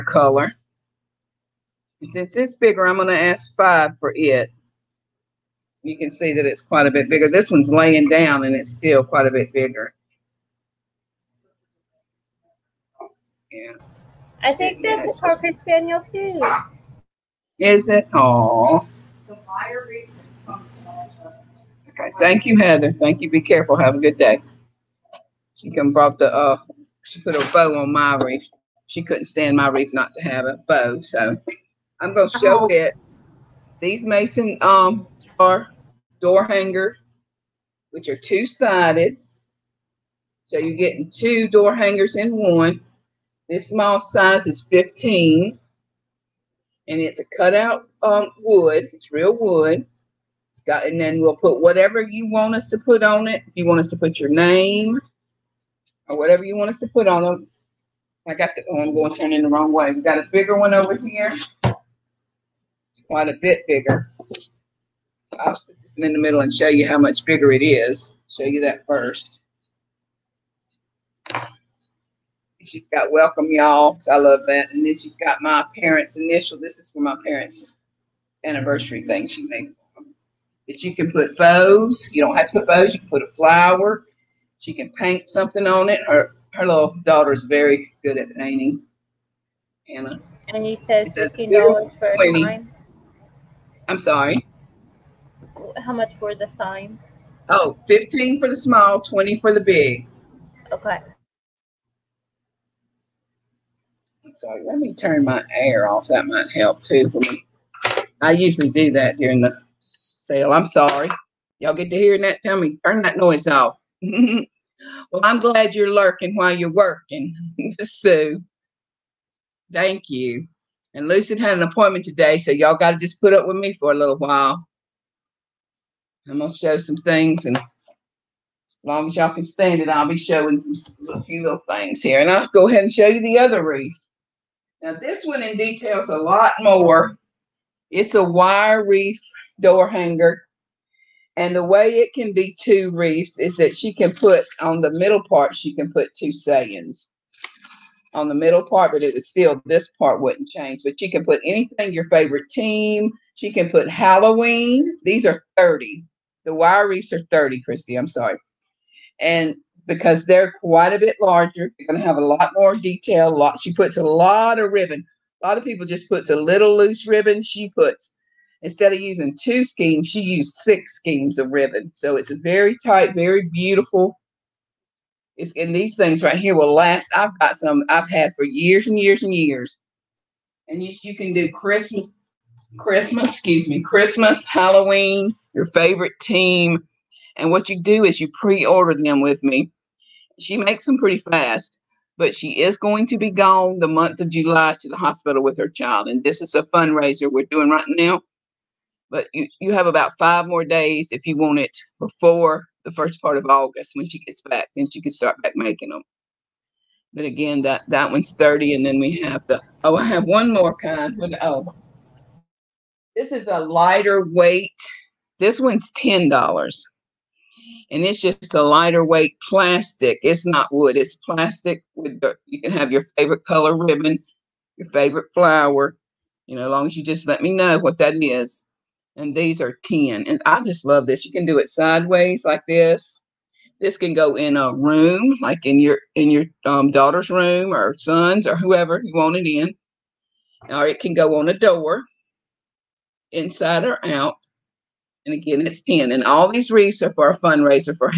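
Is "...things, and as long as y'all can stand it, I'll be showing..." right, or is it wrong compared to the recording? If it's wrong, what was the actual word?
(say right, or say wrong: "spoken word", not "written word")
right.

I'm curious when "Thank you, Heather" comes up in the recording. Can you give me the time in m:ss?
0:22.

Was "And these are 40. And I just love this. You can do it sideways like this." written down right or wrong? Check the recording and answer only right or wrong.
wrong.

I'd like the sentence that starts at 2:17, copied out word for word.
It's a wire wreath door hanger.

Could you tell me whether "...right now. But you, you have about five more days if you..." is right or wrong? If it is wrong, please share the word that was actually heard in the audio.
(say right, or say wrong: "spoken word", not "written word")
right.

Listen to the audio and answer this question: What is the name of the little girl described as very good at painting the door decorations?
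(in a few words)
Anna.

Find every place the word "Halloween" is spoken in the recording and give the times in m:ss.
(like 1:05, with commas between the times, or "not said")
2:33, 3:04.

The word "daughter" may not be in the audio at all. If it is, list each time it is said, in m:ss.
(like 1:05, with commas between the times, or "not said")
1:27, 3:56.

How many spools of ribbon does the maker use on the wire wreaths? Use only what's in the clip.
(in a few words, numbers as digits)
6.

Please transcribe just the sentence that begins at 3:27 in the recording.
But again, that, that one's 30.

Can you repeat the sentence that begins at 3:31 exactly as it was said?
oh, this is a lighter weight this one's $10.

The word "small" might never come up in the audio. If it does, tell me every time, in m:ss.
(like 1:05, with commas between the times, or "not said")
0:43, 1:38.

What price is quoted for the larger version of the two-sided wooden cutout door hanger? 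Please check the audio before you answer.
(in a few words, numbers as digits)
$20.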